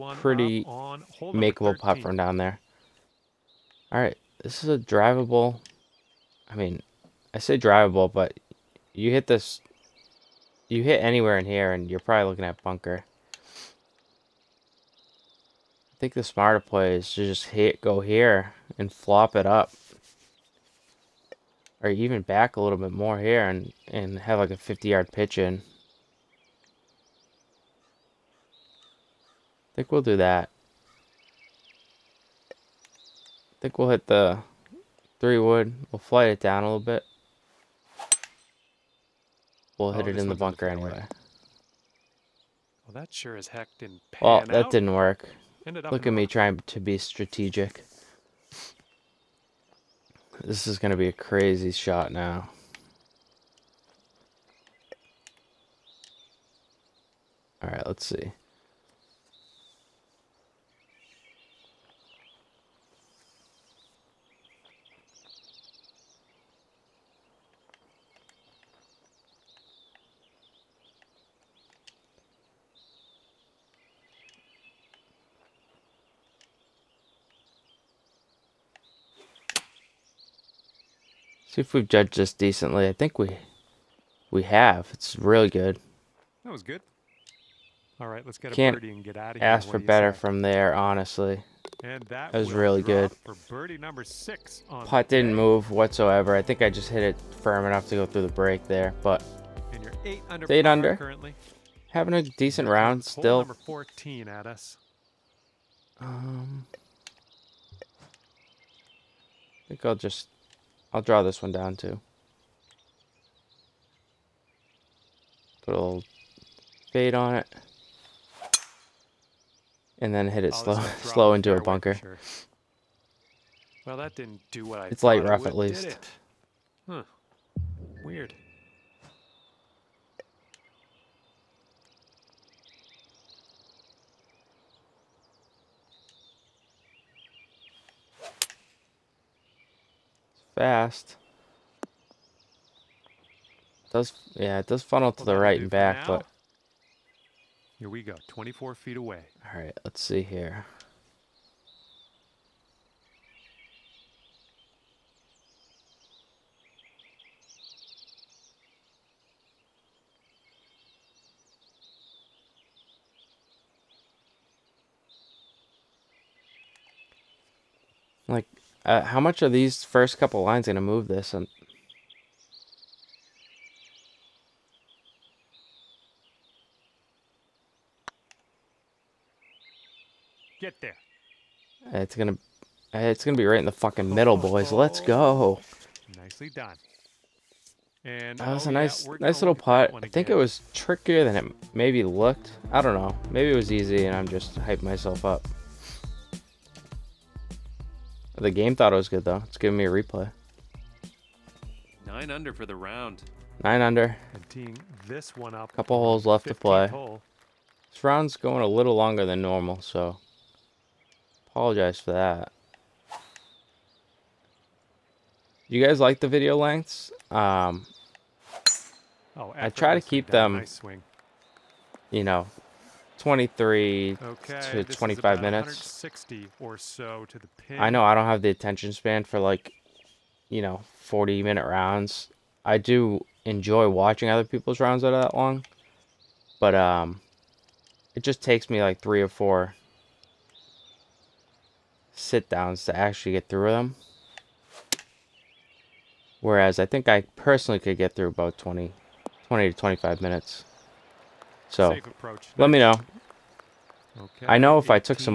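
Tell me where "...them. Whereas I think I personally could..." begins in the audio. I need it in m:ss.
4:03.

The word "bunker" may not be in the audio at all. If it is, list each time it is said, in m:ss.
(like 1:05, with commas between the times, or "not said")
0:12, 0:40, 2:01.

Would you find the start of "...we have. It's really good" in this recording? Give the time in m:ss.
1:24.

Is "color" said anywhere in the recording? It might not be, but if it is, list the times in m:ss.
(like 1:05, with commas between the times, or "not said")
not said.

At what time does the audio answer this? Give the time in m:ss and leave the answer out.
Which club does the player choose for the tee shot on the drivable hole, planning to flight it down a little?
0:35.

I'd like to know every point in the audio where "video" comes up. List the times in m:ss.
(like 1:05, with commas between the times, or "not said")
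3:36.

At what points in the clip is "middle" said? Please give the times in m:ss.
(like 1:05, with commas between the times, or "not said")
3:04.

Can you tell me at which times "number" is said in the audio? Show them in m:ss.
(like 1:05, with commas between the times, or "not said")
1:33, 1:43.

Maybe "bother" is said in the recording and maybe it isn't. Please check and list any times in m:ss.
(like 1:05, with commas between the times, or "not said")
not said.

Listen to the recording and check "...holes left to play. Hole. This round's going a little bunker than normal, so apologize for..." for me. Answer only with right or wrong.
wrong.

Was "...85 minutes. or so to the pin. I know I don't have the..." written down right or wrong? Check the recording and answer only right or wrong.
wrong.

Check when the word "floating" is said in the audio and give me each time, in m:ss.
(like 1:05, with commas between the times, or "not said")
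not said.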